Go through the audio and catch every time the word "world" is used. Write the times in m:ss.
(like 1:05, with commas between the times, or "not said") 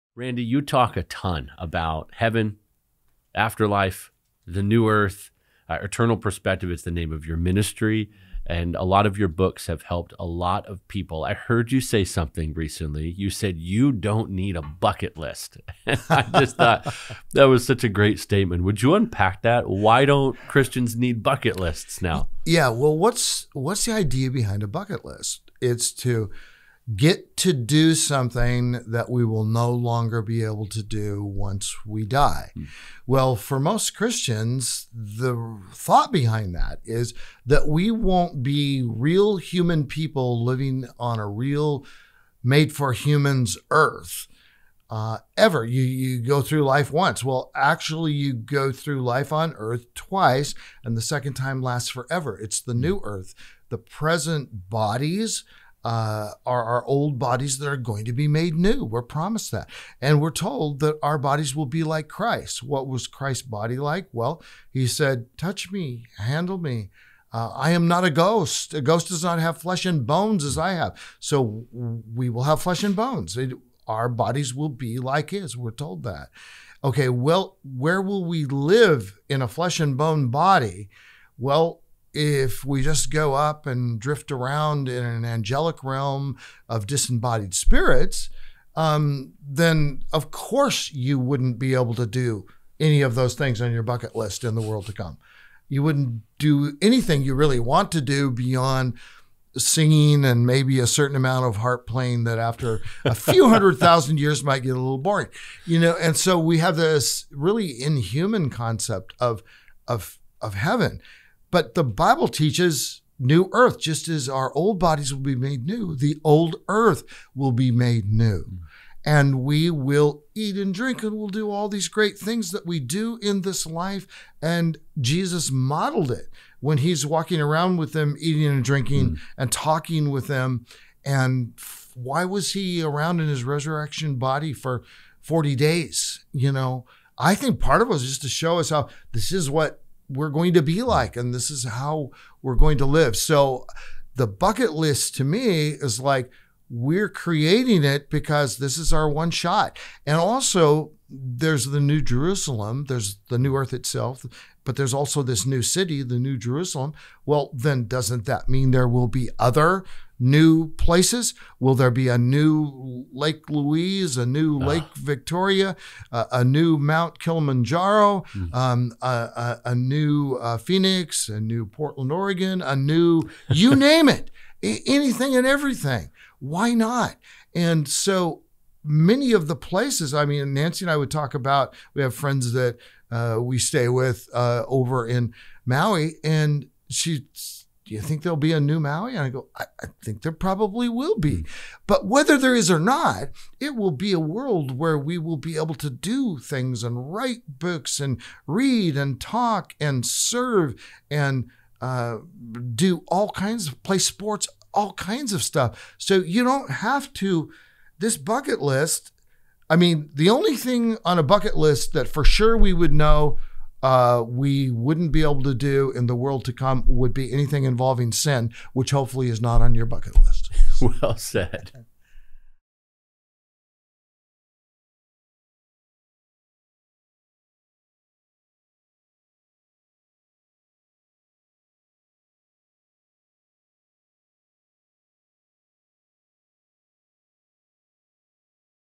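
1:34, 3:14, 3:36.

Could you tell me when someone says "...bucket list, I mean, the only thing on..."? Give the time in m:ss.
3:28.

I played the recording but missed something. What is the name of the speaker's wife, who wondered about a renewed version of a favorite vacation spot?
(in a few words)
Nancy.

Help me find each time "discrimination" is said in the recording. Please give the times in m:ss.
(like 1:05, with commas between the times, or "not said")
not said.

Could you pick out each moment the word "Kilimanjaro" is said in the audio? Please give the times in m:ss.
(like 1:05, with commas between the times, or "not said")
2:47.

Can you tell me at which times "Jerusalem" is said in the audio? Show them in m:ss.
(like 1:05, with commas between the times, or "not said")
2:32, 2:36.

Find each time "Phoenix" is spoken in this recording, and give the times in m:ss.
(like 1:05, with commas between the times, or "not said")
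2:50.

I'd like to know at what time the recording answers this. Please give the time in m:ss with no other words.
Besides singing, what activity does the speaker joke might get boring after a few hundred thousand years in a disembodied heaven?
1:41.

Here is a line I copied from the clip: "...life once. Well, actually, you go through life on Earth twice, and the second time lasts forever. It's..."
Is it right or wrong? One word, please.
right.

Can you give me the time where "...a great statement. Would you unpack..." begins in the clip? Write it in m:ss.
0:17.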